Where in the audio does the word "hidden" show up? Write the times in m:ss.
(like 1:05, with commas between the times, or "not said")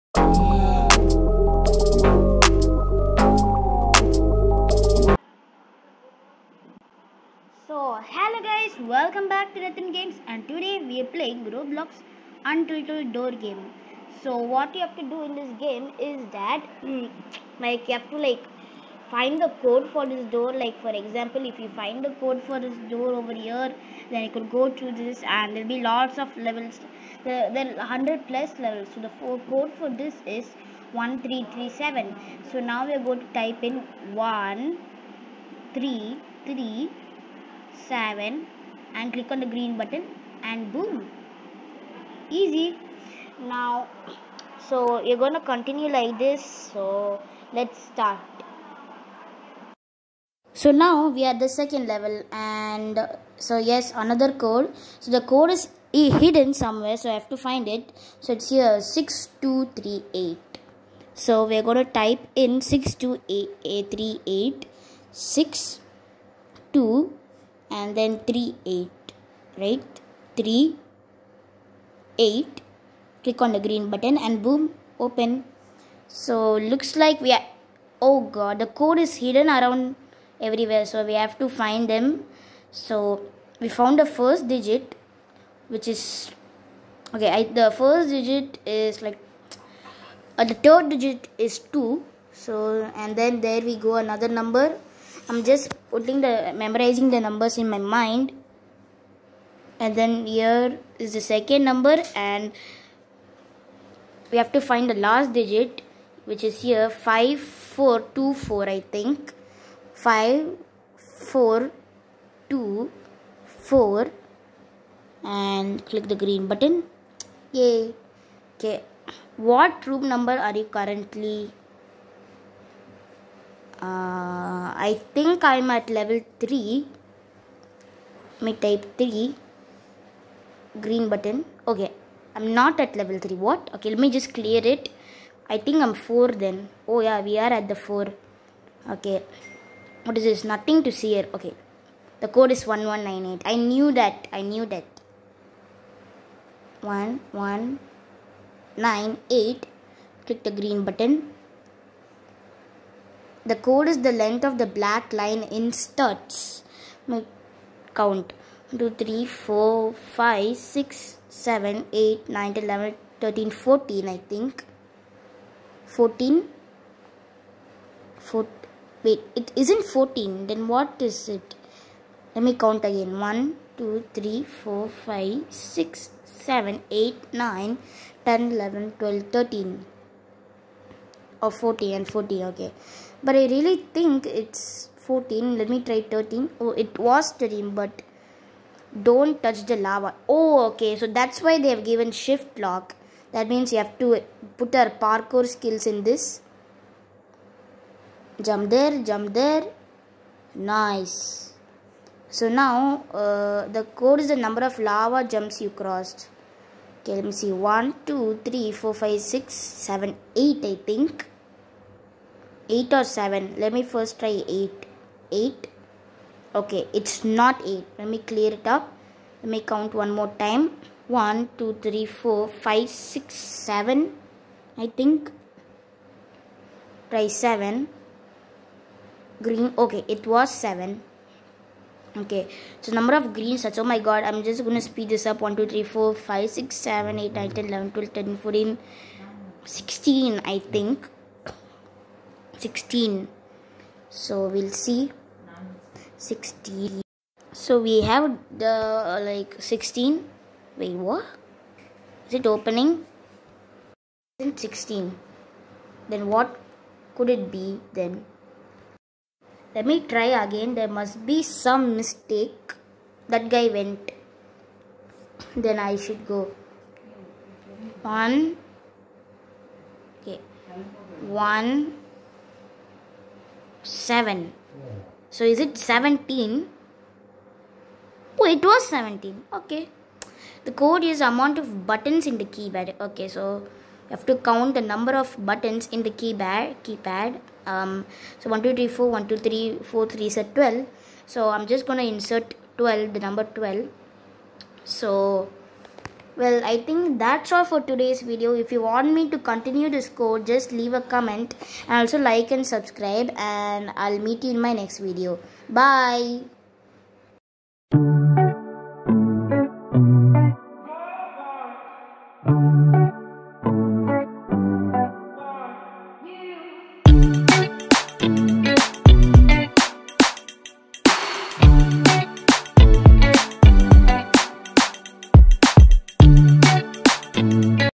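0:55, 1:19.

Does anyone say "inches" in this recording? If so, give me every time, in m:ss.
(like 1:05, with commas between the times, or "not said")
not said.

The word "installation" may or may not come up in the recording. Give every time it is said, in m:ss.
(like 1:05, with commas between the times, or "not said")
not said.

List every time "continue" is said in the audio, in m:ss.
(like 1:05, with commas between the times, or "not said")
0:45, 4:59.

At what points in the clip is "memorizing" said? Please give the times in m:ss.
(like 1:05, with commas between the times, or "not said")
1:36.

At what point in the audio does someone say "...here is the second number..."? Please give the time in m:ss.
1:40.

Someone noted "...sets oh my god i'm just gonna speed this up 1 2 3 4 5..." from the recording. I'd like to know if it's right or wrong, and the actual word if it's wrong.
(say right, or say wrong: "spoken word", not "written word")
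right.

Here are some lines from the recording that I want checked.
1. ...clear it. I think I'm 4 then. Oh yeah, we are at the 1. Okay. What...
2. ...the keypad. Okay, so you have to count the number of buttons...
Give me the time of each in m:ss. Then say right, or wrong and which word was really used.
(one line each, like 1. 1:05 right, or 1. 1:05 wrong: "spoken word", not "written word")
1. 2:14 wrong: "4", not "1"
2. 4:42 right.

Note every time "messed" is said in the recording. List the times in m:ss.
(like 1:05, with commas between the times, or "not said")
not said.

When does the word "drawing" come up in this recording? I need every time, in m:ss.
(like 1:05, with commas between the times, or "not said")
not said.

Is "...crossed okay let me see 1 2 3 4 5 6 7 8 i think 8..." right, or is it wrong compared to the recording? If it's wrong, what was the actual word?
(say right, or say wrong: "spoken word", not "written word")
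right.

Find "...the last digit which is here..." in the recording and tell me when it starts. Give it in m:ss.
1:44.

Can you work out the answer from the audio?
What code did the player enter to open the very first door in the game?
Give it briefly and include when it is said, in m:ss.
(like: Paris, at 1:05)
1337, at 0:30.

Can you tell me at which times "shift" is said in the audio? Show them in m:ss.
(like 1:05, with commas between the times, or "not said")
3:12.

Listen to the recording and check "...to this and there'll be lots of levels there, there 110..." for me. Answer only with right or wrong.
wrong.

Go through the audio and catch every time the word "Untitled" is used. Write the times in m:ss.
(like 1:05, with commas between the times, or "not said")
0:12.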